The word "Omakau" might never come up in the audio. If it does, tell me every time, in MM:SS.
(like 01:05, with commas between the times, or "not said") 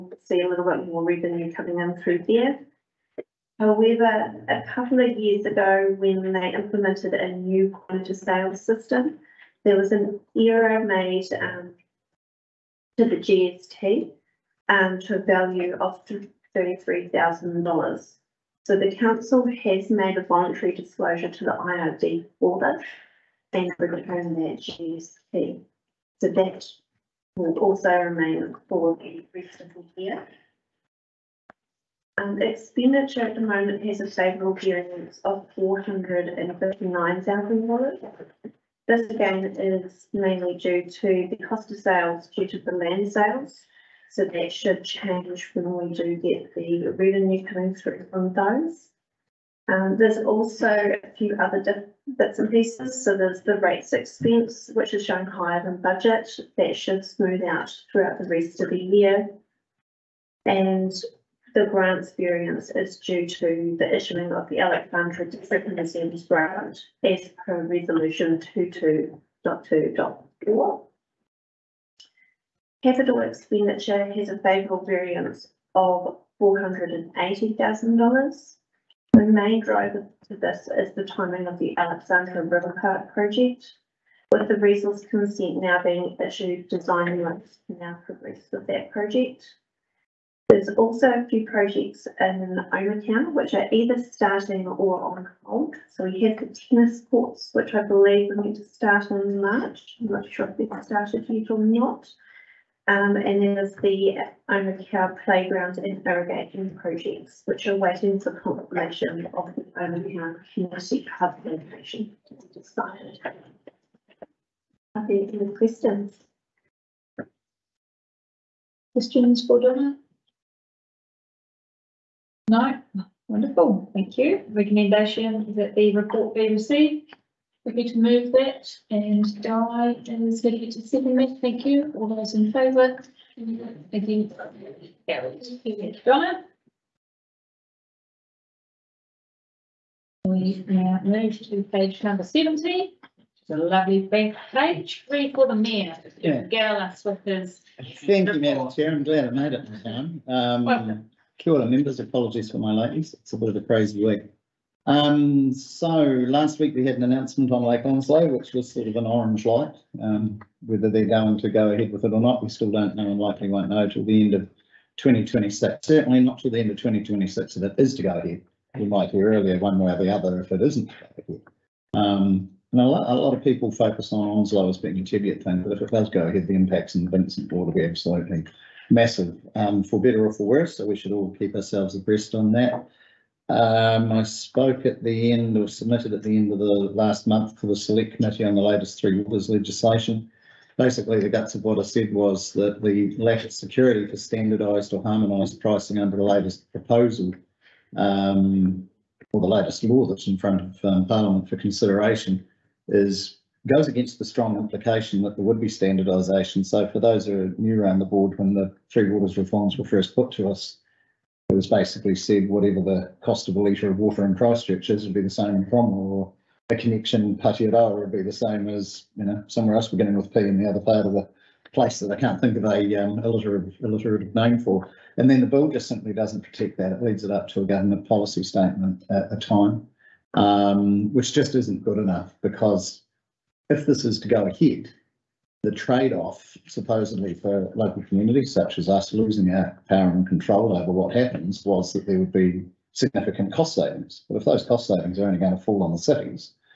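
01:32, 01:44, 01:49.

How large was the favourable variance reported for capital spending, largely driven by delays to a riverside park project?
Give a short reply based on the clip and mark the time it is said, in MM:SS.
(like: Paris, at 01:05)
$480,000, at 01:16.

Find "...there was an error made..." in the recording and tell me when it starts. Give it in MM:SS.
00:09.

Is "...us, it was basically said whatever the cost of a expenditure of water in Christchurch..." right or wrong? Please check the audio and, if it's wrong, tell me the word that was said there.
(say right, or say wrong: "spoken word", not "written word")
wrong: "litre", not "expenditure".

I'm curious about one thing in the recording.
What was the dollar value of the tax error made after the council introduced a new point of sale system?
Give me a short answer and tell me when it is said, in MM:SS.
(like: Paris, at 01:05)
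$33,000, at 00:16.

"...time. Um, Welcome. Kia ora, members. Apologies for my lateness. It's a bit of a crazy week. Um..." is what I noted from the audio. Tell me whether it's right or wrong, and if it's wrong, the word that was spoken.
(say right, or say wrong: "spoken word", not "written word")
right.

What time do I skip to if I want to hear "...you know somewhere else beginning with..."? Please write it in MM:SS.
03:39.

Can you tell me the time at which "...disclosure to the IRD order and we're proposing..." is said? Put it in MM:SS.
00:20.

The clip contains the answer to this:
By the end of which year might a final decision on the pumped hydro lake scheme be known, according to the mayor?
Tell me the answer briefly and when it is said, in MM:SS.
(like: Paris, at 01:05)
2026, at 02:46.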